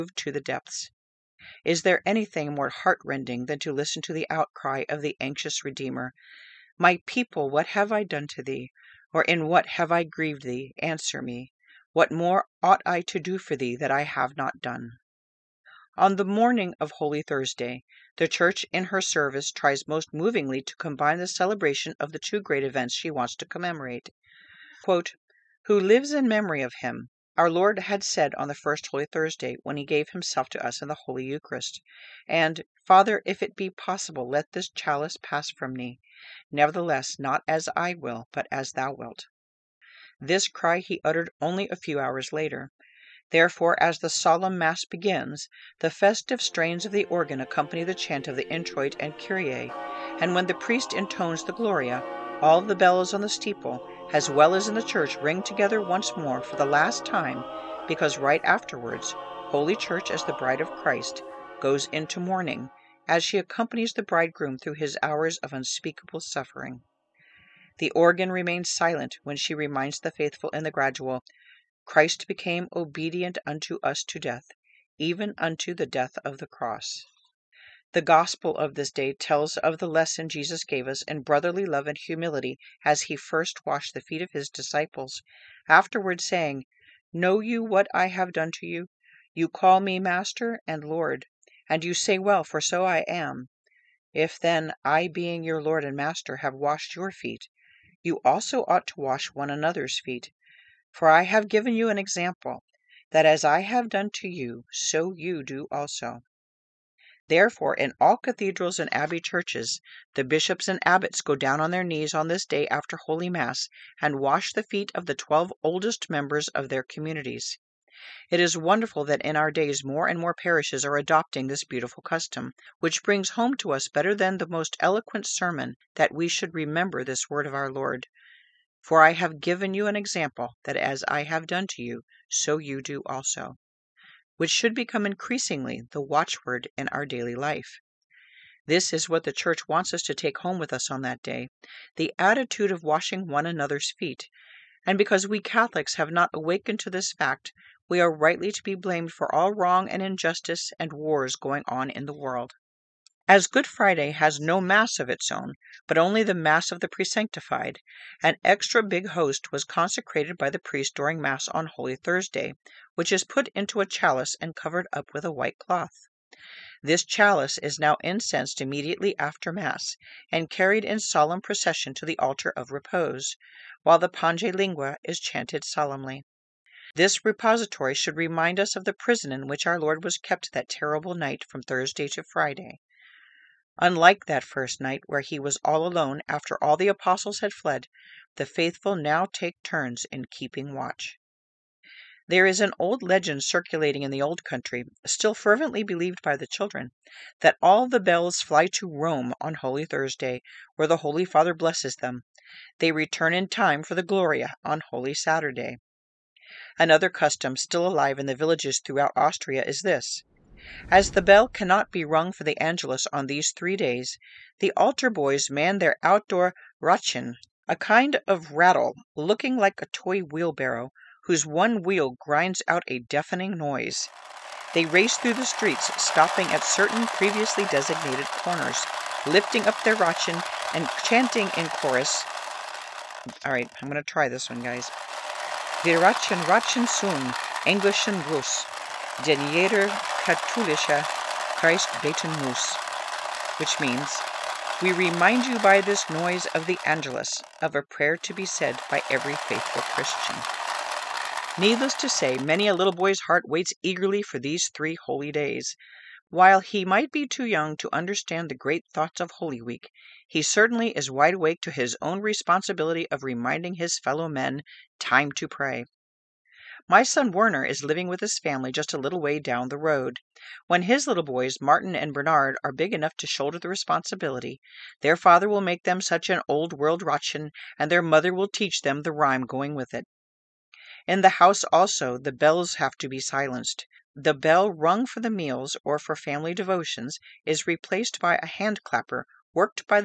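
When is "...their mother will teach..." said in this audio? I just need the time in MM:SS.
04:37.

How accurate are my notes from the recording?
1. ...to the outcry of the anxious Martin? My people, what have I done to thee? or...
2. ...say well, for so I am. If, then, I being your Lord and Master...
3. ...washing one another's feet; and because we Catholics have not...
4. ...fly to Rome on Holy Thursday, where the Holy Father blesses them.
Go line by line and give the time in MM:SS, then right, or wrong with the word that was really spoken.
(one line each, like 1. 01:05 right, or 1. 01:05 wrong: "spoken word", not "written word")
1. 00:04 wrong: "Redeemer", not "Martin"
2. 01:31 right
3. 02:22 right
4. 03:18 right.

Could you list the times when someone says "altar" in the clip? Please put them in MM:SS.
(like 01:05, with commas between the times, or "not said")
02:52, 03:34.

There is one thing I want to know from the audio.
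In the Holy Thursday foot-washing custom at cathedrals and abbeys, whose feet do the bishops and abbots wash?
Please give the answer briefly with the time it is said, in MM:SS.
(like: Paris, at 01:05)
Twelve oldest members, at 01:55.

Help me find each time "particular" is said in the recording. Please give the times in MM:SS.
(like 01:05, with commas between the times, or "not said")
not said.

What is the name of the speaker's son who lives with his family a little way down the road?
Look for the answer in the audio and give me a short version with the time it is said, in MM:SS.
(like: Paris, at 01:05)
Werner, at 04:27.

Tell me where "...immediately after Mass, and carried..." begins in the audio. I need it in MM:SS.
02:48.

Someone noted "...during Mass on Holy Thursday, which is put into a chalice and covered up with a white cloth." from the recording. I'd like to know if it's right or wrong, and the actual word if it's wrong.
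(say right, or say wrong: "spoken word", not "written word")
right.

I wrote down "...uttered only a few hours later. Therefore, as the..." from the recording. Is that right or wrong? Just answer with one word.
right.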